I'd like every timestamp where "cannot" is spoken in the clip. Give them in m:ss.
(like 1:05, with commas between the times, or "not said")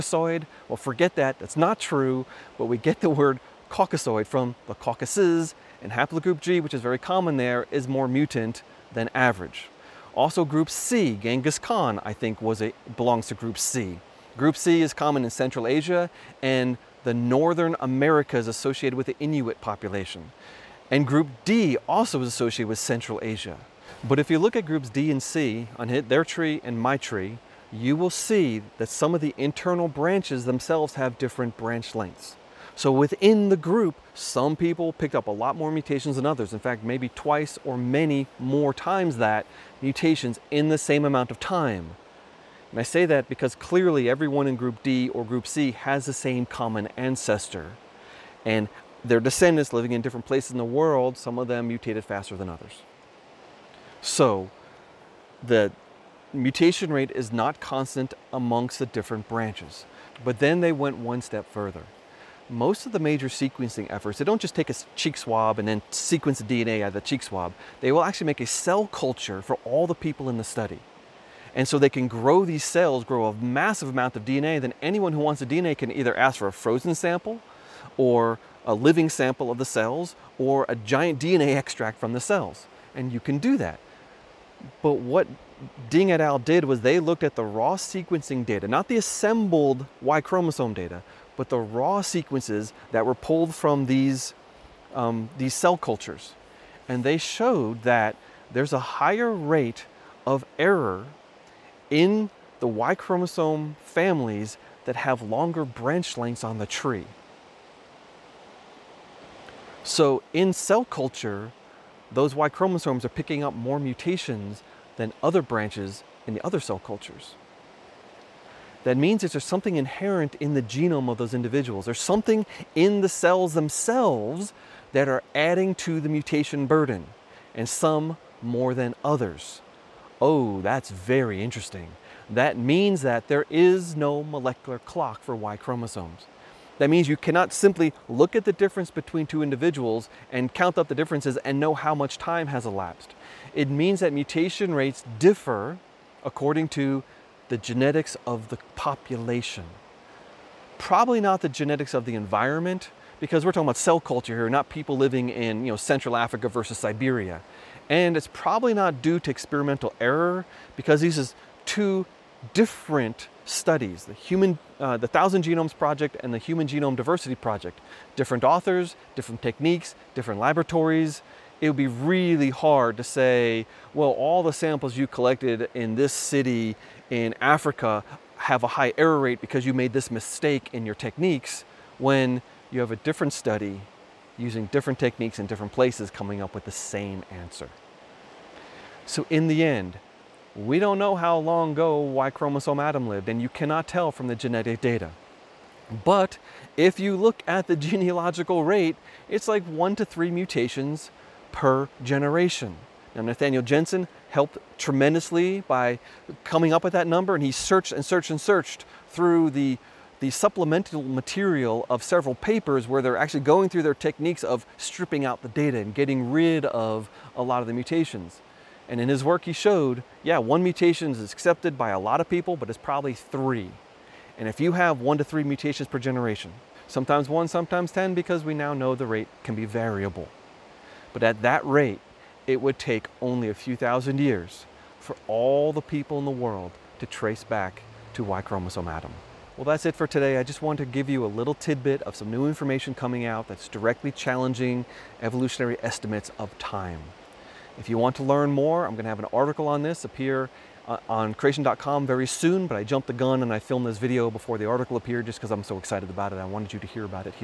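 2:17, 3:13.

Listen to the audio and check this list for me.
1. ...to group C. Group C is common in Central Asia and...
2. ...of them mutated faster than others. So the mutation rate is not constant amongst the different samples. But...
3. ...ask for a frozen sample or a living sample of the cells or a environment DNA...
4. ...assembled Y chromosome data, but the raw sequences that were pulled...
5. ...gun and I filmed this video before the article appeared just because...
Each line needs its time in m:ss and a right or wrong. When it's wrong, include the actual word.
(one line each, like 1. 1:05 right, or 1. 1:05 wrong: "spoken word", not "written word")
1. 0:13 right
2. 0:51 wrong: "branches", not "samples"
3. 1:16 wrong: "giant", not "environment"
4. 1:28 right
5. 4:13 right.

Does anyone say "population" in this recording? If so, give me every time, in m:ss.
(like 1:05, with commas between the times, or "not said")
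0:19, 2:28.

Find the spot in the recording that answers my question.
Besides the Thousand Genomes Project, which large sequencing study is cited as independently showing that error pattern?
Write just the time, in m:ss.
2:46.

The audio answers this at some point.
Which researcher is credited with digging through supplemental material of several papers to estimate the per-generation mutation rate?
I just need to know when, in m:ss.
3:23.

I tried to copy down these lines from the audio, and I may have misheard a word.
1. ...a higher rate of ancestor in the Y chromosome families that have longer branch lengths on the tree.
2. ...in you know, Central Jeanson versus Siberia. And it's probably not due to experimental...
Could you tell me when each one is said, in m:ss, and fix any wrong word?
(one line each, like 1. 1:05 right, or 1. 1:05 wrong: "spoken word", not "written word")
1. 1:38 wrong: "error", not "ancestor"
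2. 2:35 wrong: "Africa", not "Jeanson".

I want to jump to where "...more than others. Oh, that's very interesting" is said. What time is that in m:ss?
2:08.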